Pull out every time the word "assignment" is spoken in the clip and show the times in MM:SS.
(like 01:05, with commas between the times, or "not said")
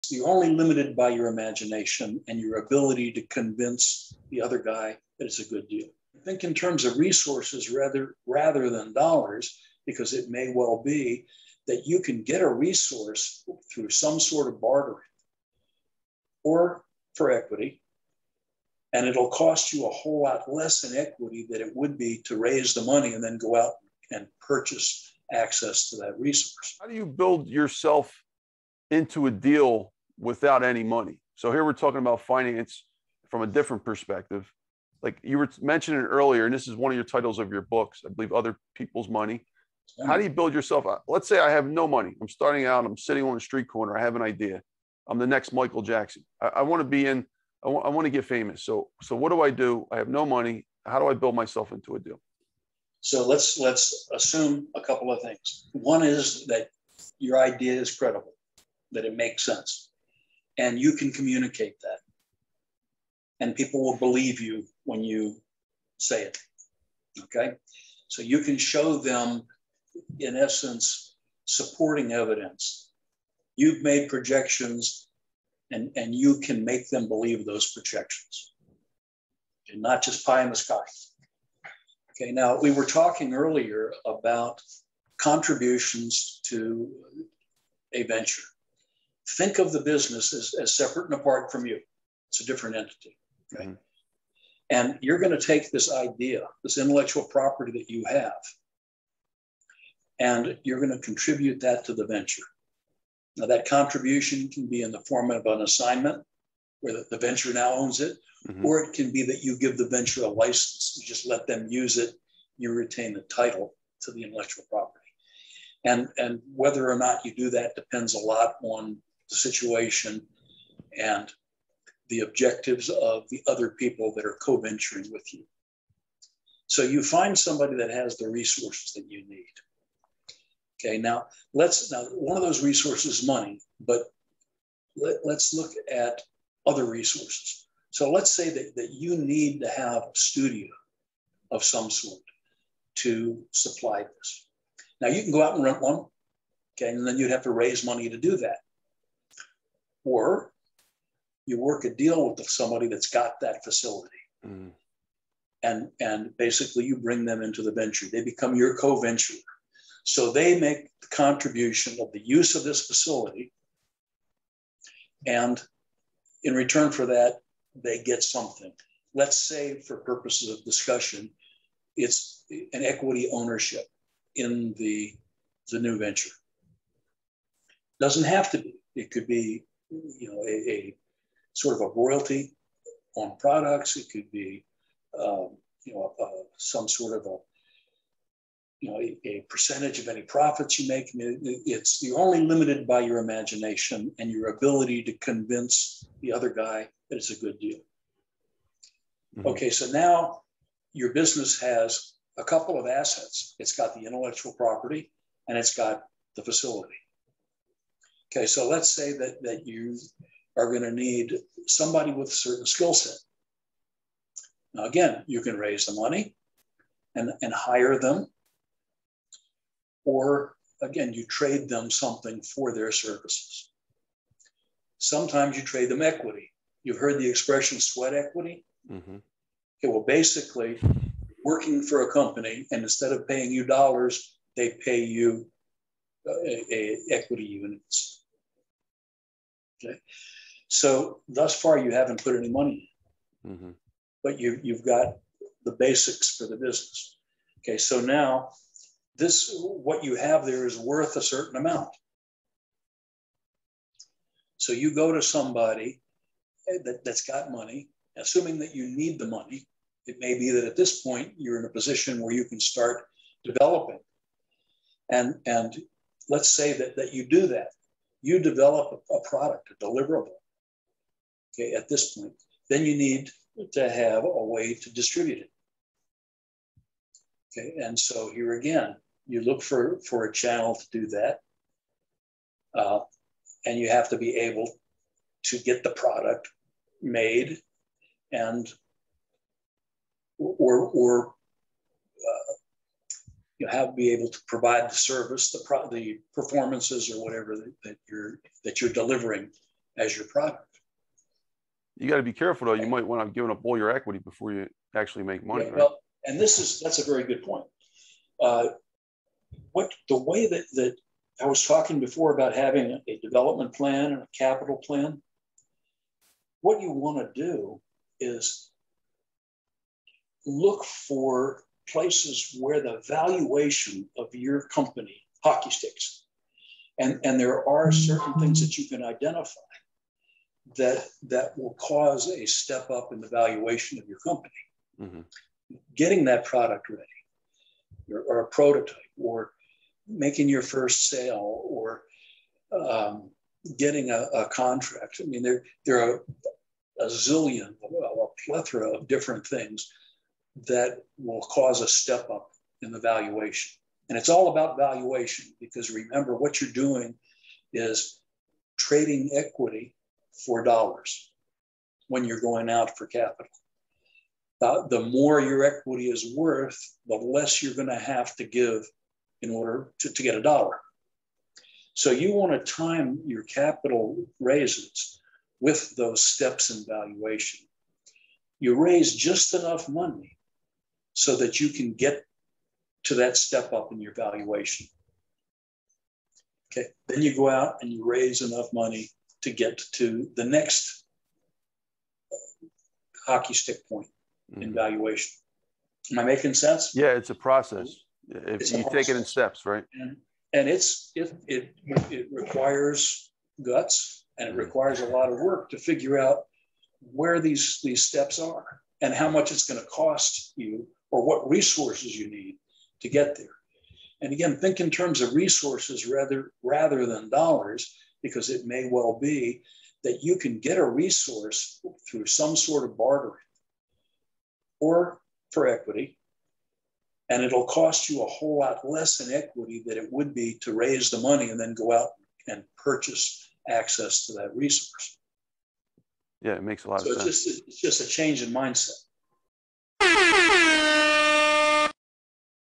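01:45.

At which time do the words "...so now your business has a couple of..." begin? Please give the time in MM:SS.
03:19.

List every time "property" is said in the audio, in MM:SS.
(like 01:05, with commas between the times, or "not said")
01:37, 01:54, 03:24.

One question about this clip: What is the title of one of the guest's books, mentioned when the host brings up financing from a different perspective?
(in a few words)
Other People's Money.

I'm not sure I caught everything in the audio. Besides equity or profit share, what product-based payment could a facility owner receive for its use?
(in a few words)
royalty.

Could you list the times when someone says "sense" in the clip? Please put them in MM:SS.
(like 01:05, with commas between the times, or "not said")
00:59, 06:36, 07:17.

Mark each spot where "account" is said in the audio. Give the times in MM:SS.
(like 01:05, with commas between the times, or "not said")
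not said.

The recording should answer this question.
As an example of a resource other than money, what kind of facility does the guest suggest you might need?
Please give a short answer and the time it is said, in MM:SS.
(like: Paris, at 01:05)
studio, at 02:20.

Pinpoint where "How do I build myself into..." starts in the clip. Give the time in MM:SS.
00:50.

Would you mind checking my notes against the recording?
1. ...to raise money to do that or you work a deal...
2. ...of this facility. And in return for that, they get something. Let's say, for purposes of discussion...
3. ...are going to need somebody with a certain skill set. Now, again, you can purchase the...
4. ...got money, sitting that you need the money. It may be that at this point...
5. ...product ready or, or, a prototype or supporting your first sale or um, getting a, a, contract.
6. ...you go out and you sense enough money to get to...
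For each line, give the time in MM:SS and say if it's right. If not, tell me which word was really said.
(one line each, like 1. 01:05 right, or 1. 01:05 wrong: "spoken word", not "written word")
1. 02:27 right
2. 02:42 right
3. 03:30 wrong: "raise", not "purchase"
4. 04:17 wrong: "assuming", not "sitting"
5. 05:36 wrong: "making", not "supporting"
6. 06:27 wrong: "raise", not "sense".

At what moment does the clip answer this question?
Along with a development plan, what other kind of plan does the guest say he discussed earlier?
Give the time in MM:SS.
05:14.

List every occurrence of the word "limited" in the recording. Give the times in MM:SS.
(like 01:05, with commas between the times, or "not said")
00:00, 03:12.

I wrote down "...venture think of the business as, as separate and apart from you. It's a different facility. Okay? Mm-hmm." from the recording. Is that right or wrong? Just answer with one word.
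wrong.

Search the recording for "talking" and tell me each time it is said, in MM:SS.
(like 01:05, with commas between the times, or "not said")
00:31, 01:22, 05:11.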